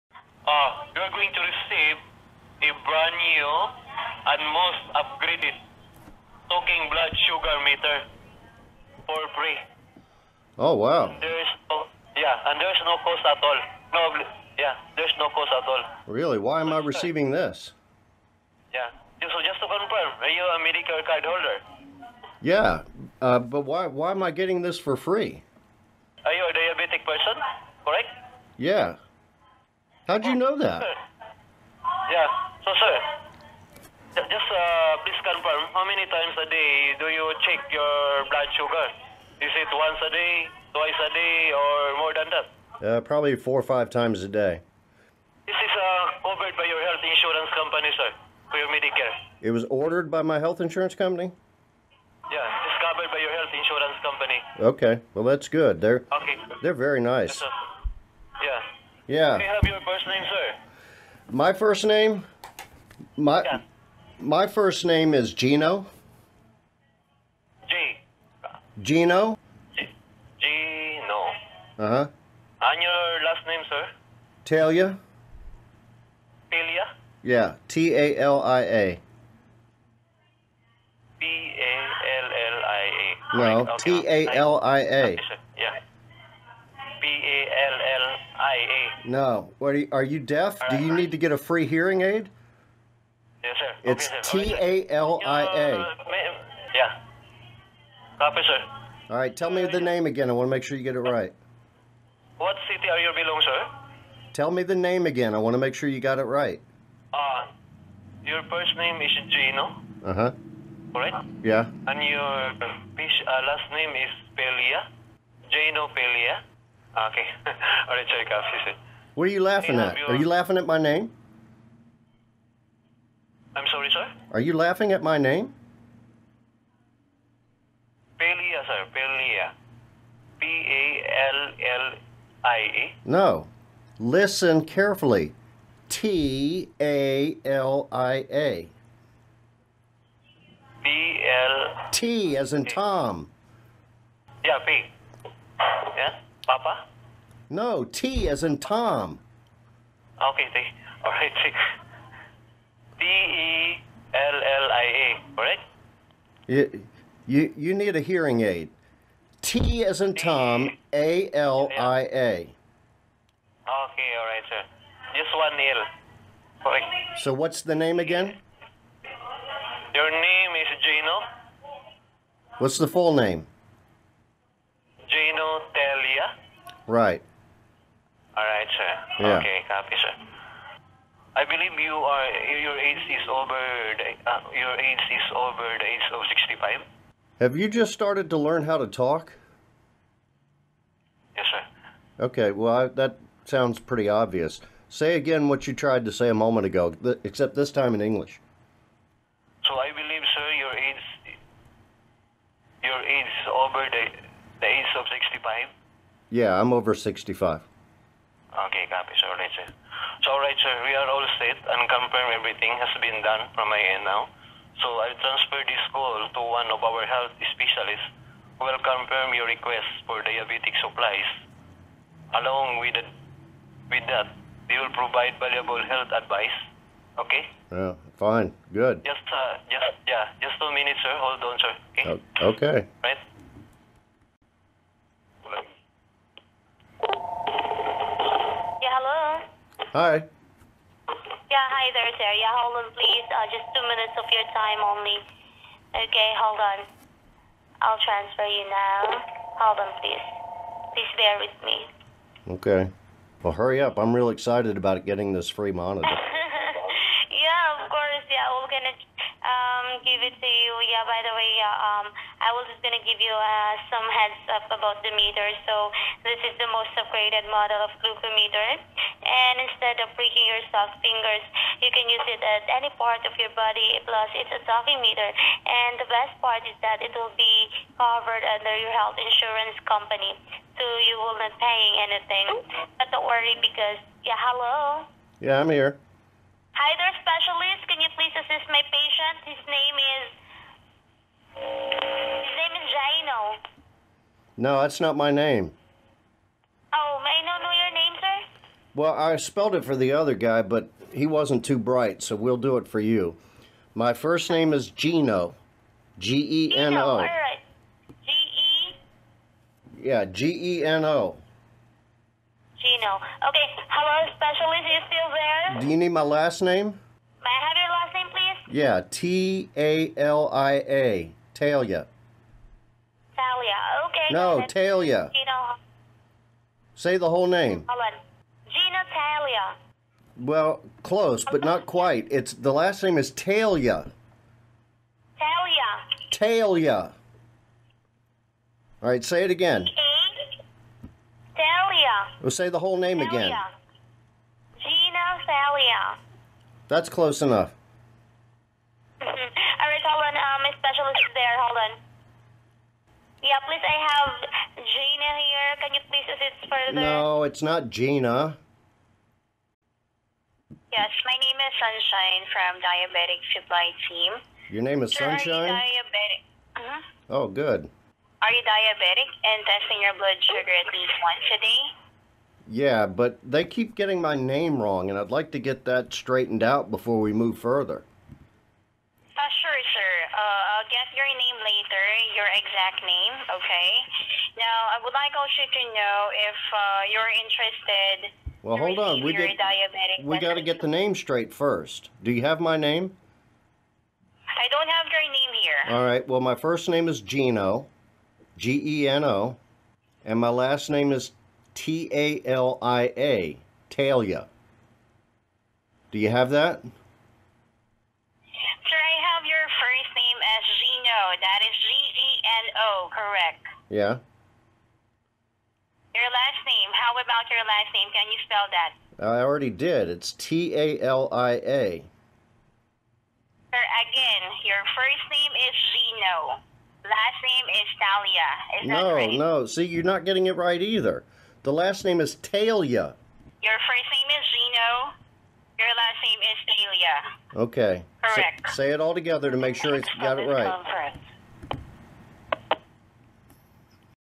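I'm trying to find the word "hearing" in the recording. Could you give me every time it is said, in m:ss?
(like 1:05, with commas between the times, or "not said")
1:31, 2:38.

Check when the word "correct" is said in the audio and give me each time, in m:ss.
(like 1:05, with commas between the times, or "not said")
0:27, 2:46, 6:53, 7:18.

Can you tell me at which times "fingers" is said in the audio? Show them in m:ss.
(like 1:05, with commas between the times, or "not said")
4:31.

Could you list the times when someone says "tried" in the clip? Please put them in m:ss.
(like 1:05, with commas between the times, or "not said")
3:15.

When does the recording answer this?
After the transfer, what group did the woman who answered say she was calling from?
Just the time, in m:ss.
6:02.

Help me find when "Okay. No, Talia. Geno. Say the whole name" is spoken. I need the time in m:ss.
5:24.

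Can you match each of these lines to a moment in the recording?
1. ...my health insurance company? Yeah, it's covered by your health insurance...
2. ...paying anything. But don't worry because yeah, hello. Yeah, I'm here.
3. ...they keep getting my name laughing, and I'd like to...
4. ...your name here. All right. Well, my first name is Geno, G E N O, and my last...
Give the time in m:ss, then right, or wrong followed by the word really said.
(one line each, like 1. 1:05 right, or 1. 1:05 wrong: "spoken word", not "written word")
1. 0:50 right
2. 4:41 right
3. 6:13 wrong: "wrong", not "laughing"
4. 6:35 right.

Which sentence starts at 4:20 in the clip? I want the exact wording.
Yeah, by the way, yeah, um, I was just going to give you uh, some heads up about the meter.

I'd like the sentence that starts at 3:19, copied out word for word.
So I believe, sir, your age your age is over the yeah, I'm over 65.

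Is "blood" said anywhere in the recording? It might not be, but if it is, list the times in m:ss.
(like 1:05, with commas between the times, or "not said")
0:06, 0:38, 6:10.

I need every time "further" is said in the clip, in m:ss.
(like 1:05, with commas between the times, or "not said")
5:56, 6:17.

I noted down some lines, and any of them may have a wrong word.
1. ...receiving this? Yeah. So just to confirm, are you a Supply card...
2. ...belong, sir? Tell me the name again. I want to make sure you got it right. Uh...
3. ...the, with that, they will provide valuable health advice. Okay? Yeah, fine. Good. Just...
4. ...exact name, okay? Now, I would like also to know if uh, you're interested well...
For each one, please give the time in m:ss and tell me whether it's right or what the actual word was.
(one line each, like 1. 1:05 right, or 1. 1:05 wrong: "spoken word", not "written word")
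1. 0:16 wrong: "Medicare", not "Supply"
2. 1:43 right
3. 3:42 right
4. 6:22 right.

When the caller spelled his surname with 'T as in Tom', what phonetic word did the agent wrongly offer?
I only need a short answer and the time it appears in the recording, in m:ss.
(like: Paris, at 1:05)
Papa, at 2:26.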